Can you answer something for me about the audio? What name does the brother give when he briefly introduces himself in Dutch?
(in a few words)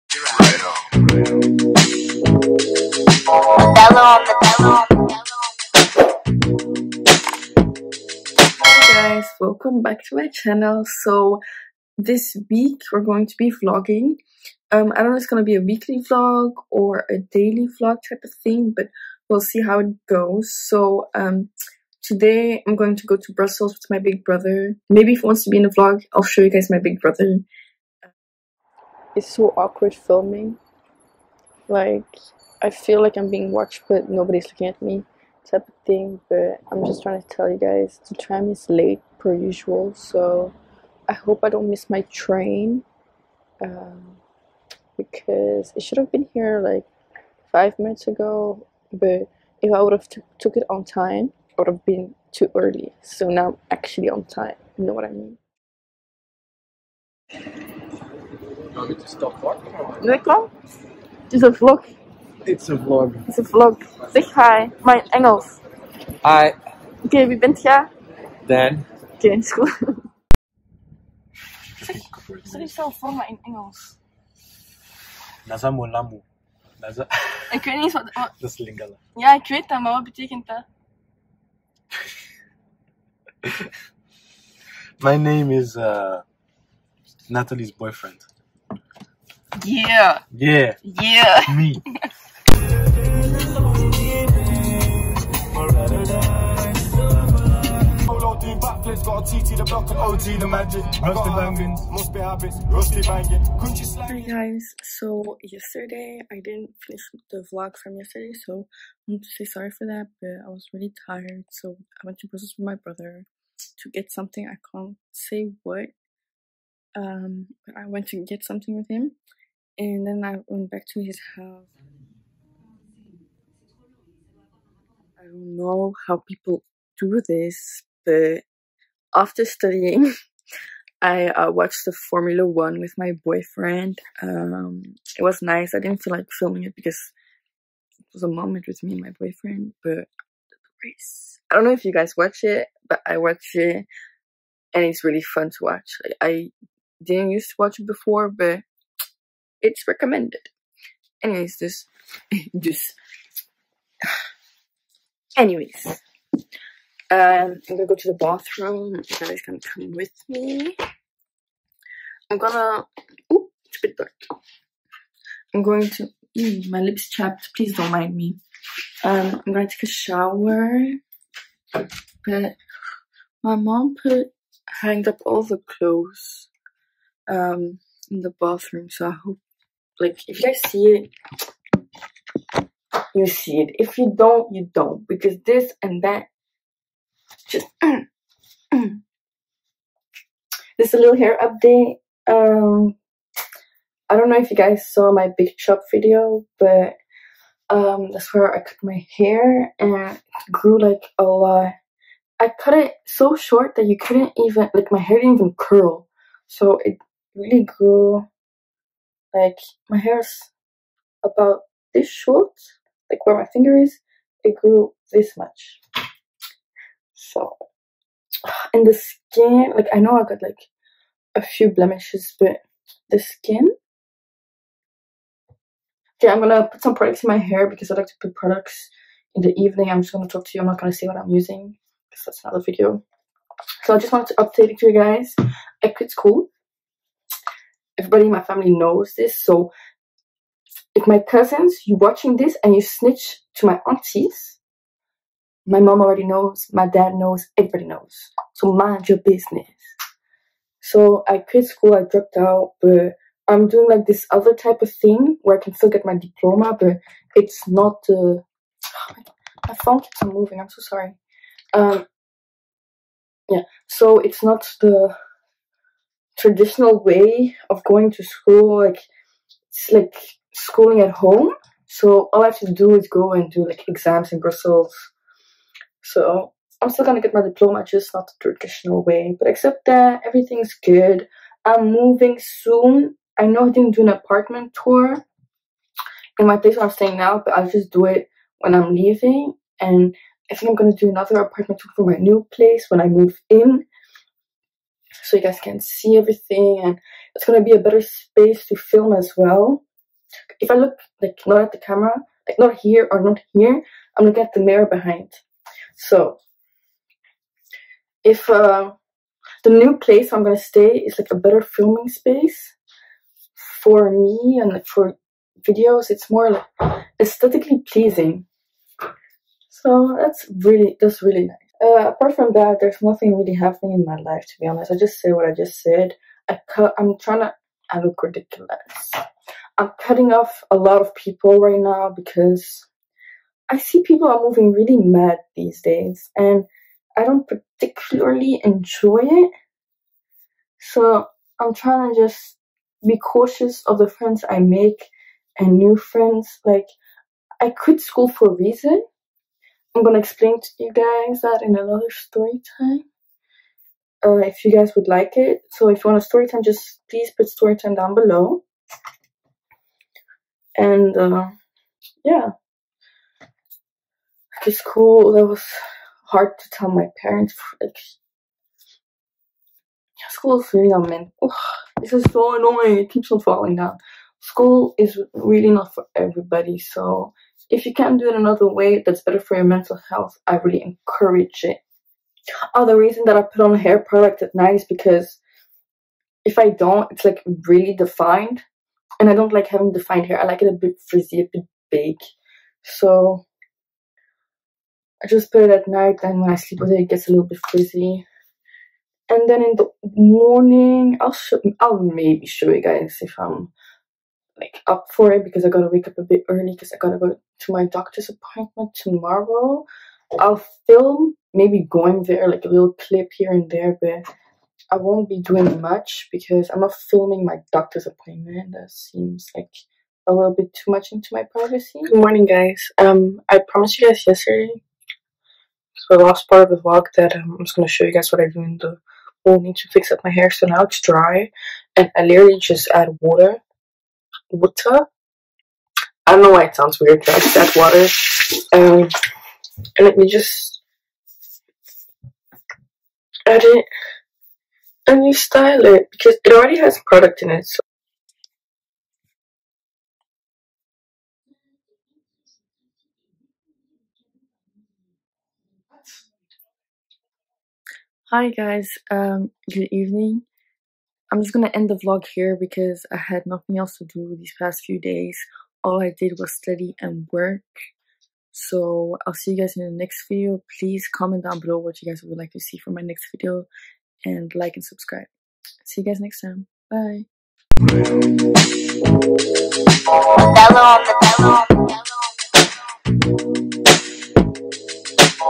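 Dan.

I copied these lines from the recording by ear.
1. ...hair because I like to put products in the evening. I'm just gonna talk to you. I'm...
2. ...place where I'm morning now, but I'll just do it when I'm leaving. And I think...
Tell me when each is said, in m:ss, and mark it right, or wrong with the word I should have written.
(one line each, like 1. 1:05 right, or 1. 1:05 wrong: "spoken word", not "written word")
1. 3:47 right
2. 4:46 wrong: "staying", not "morning".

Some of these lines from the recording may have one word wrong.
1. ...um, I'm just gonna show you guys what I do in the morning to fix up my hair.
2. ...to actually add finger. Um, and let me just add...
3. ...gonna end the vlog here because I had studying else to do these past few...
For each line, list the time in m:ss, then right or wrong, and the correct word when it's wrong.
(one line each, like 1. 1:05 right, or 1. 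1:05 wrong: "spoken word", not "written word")
1. 7:07 right
2. 7:17 wrong: "water", not "finger"
3. 7:41 wrong: "nothing", not "studying".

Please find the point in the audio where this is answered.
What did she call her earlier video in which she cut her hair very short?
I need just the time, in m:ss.
3:15.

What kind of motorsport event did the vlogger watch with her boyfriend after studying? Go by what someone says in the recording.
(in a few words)
Formula One.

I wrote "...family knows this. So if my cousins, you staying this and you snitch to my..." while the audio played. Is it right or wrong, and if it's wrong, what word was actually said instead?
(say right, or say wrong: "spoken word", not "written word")
wrong: "watching", not "staying".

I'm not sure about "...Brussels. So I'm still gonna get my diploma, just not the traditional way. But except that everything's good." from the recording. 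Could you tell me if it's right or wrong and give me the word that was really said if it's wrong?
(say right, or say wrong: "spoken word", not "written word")
right.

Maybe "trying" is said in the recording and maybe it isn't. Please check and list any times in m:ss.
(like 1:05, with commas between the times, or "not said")
0:37, 5:27, 5:41.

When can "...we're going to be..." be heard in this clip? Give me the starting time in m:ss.
0:12.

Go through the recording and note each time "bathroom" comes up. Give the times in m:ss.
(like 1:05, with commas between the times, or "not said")
2:38, 2:58.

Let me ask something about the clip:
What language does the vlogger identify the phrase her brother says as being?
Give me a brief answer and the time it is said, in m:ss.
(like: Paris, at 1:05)
Lingala, at 1:18.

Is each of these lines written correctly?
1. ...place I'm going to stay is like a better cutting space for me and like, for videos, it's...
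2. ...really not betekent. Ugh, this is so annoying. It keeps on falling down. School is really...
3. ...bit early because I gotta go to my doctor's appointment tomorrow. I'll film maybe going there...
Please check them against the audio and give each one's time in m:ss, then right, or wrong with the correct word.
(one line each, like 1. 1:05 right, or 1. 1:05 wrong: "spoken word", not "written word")
1. 5:09 wrong: "filming", not "cutting"
2. 6:10 wrong: "meant", not "betekent"
3. 6:46 right.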